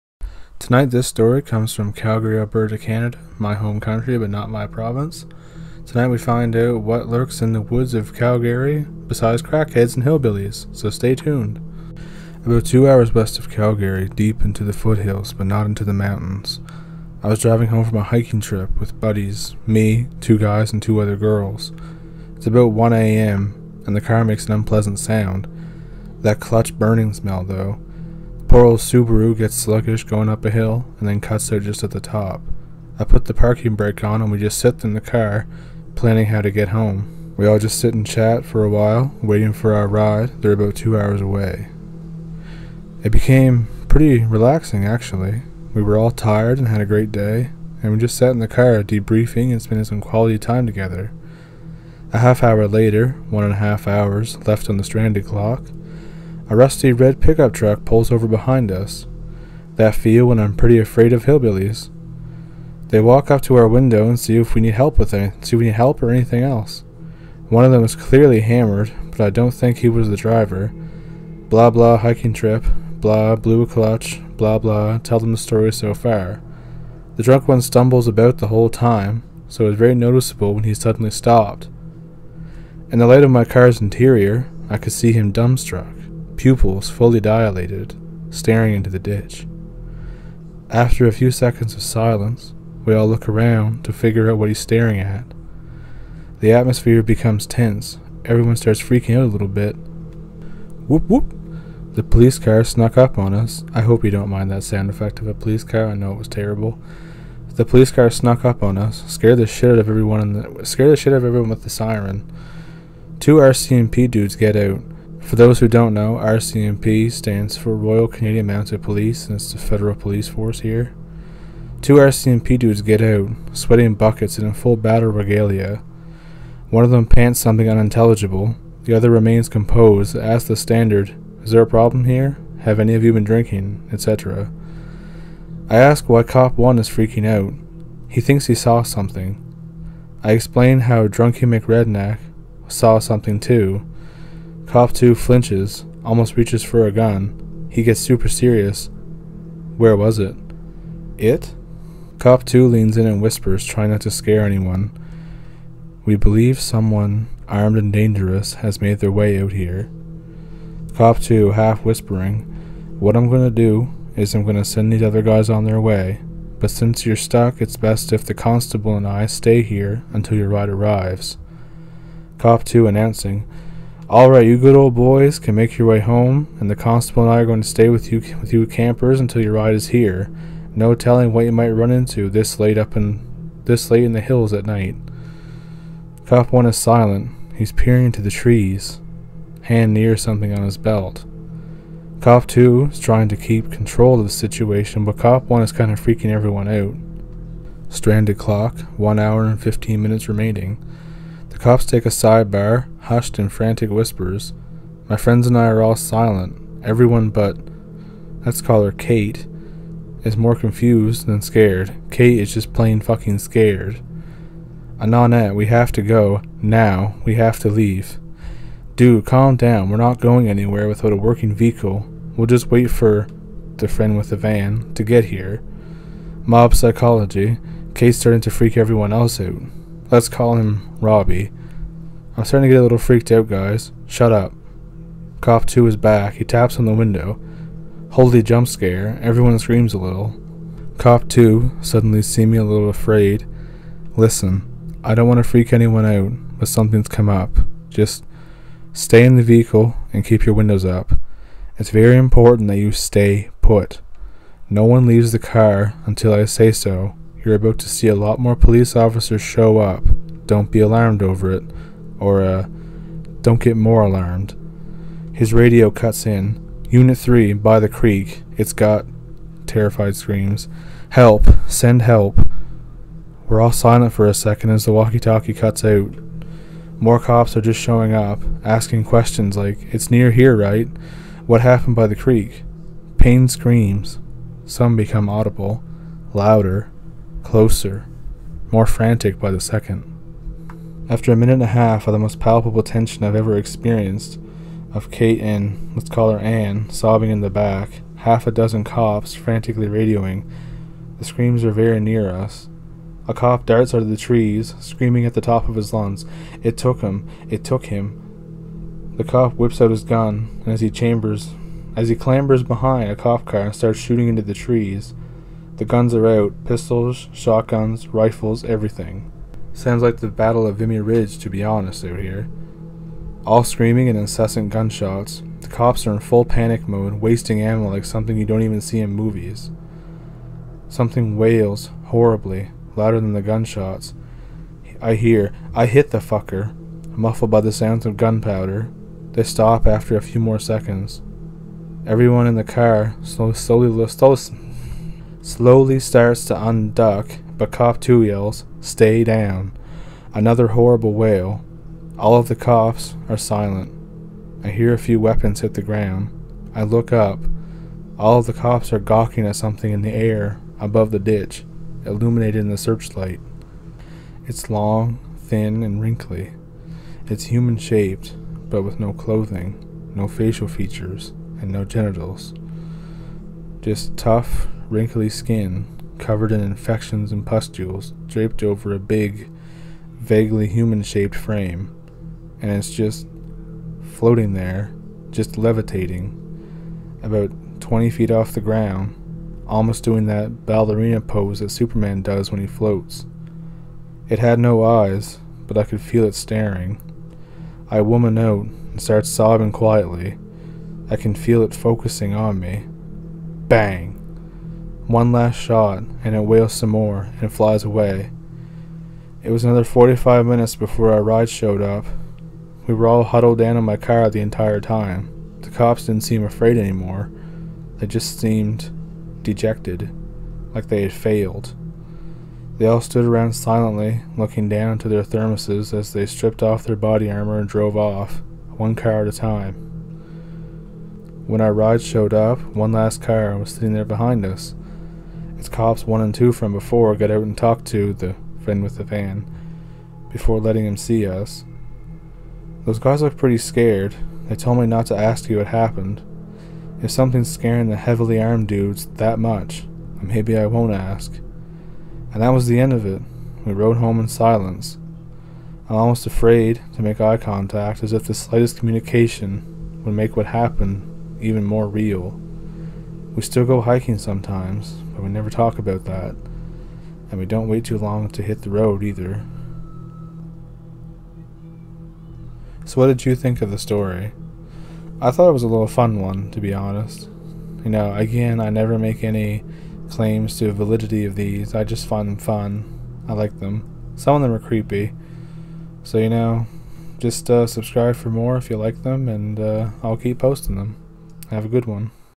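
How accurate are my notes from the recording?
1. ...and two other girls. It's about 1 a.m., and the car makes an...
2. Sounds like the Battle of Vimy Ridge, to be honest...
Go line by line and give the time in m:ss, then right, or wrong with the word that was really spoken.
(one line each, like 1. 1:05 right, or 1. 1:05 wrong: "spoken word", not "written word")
1. 0:20 right
2. 5:19 right.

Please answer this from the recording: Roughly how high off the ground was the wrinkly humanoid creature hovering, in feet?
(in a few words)
20 feet.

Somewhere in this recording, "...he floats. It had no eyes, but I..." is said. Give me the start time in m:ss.
6:32.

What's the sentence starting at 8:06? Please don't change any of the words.
So, you know, just uh, subscribe for more if you like them, and uh, I'll keep posting them.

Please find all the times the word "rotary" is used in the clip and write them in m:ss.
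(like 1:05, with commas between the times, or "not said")
not said.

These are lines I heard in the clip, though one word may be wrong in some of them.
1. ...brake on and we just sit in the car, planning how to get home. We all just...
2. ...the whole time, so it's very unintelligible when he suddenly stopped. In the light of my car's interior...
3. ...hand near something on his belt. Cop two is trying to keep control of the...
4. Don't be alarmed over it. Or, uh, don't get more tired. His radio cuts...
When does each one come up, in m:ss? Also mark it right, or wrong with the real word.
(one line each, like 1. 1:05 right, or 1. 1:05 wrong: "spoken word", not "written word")
1. 0:33 right
2. 1:18 wrong: "noticeable", not "unintelligible"
3. 3:09 right
4. 4:20 wrong: "alarmed", not "tired".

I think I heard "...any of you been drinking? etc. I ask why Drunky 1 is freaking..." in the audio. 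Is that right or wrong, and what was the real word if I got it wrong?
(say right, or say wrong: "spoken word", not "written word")
wrong: "Cop", not "Drunky".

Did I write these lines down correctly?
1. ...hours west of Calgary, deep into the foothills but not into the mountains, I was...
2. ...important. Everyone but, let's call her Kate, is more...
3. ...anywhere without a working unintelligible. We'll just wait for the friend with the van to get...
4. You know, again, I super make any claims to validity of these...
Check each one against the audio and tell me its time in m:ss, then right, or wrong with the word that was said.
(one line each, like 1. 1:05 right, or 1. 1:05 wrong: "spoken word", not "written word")
1. 0:12 right
2. 3:25 wrong: "silent", not "important"
3. 3:40 wrong: "vehicle", not "unintelligible"
4. 7:57 wrong: "never", not "super".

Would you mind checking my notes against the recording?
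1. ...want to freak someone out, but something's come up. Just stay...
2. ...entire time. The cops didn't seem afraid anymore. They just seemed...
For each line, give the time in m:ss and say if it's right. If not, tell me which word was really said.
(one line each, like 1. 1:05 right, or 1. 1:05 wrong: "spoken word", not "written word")
1. 4:05 wrong: "anyone", not "someone"
2. 6:54 right.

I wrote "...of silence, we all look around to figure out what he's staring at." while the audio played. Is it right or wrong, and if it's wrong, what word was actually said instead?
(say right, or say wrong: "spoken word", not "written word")
right.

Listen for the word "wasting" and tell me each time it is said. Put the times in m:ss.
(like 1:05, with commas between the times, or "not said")
5:27.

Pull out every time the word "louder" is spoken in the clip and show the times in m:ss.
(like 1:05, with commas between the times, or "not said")
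4:46, 5:32.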